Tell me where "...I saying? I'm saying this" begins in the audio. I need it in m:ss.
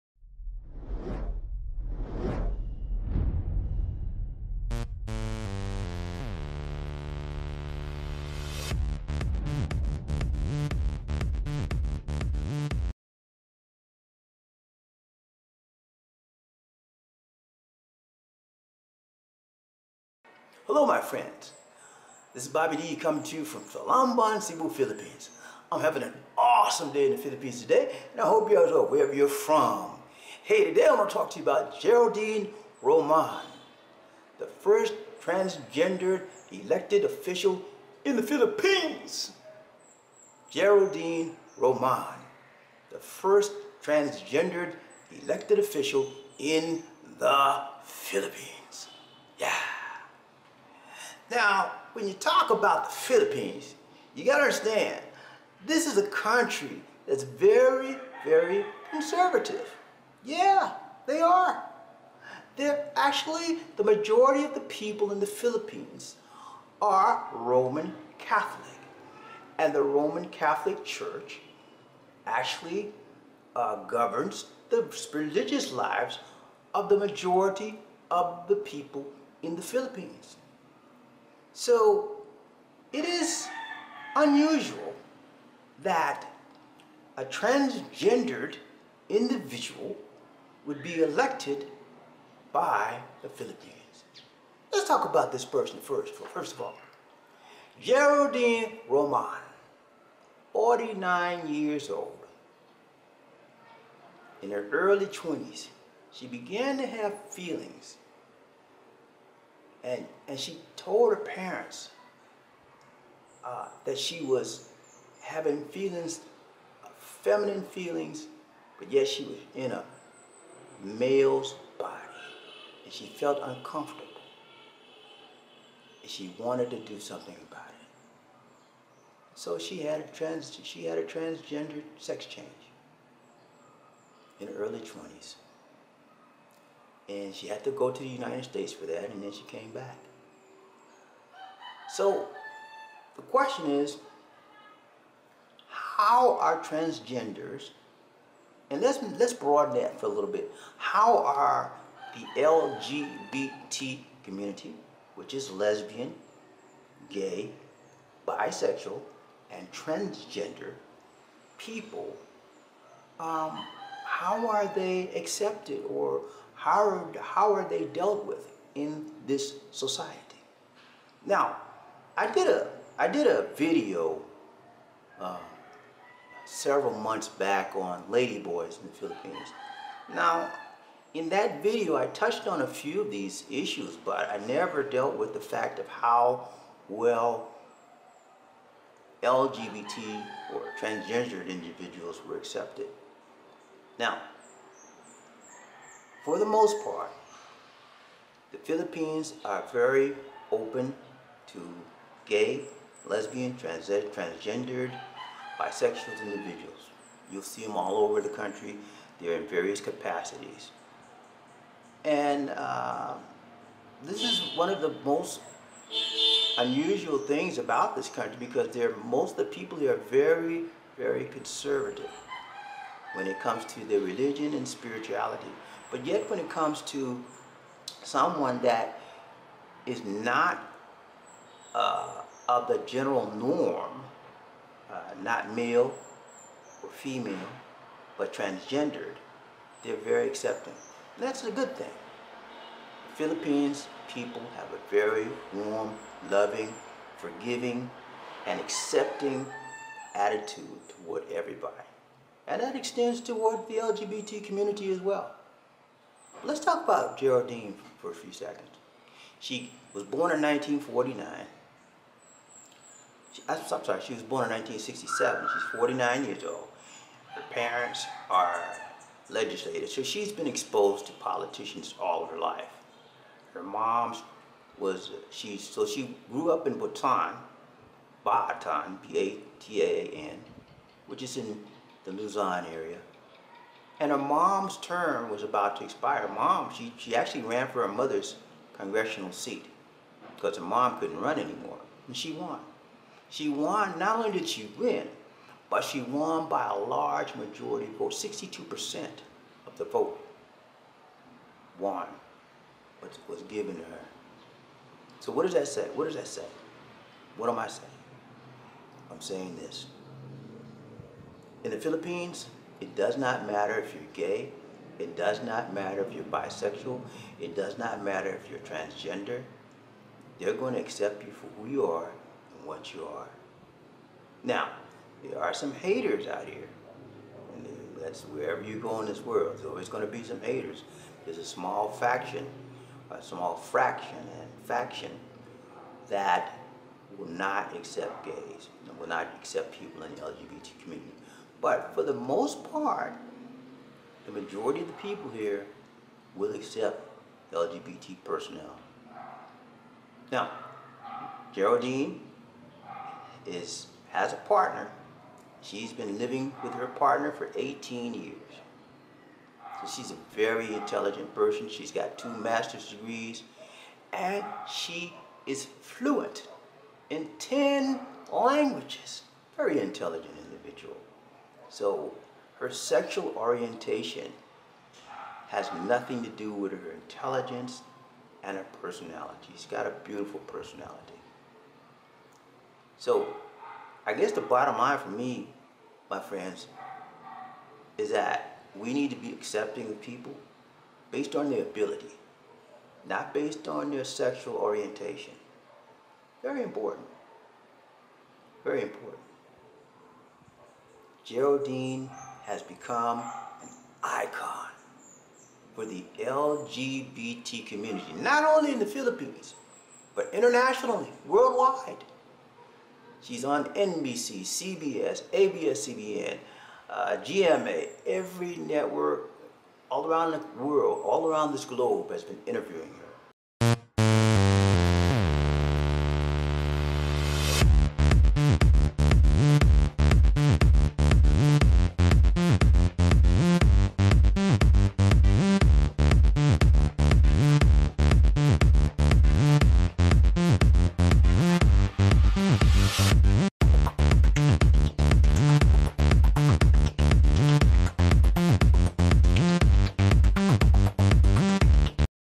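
5:07.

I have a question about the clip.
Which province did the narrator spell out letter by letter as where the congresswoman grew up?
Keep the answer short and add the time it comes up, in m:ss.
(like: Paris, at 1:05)
Bataan, at 4:38.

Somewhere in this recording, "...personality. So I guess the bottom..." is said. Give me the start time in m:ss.
6:20.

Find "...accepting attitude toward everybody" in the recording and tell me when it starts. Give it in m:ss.
4:08.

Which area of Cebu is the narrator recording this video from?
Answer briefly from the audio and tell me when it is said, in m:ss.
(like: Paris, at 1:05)
Talamban, at 0:23.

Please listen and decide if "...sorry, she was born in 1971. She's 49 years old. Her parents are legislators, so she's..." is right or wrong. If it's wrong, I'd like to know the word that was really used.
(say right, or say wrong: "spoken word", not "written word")
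wrong: "1967", not "1971".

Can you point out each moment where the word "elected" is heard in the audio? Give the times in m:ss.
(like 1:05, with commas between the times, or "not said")
0:36, 0:45, 1:31.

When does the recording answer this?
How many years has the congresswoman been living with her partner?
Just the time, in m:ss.
5:57.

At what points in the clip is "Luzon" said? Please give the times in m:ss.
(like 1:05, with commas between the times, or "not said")
4:42.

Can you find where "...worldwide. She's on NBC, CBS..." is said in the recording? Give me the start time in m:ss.
6:51.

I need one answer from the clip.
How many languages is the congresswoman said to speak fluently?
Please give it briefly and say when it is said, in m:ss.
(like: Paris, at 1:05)
10, at 6:07.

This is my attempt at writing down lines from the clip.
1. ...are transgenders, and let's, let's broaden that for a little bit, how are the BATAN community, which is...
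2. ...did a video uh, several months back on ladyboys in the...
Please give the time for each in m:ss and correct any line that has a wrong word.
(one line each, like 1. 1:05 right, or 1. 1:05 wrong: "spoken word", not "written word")
1. 2:26 wrong: "LGBT", not "BATAN"
2. 2:53 right.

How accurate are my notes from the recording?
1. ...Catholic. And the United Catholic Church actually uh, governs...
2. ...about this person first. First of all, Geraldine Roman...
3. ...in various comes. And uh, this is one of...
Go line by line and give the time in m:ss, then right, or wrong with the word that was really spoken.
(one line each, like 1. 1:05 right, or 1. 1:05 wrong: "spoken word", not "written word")
1. 1:08 wrong: "Roman", not "United"
2. 1:35 right
3. 3:29 wrong: "capacities", not "comes".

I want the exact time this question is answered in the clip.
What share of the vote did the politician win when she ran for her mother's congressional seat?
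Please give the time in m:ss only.
4:58.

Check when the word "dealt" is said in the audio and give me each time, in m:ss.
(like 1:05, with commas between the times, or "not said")
2:47, 3:04.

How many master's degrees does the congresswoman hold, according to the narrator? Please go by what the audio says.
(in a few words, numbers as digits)
2.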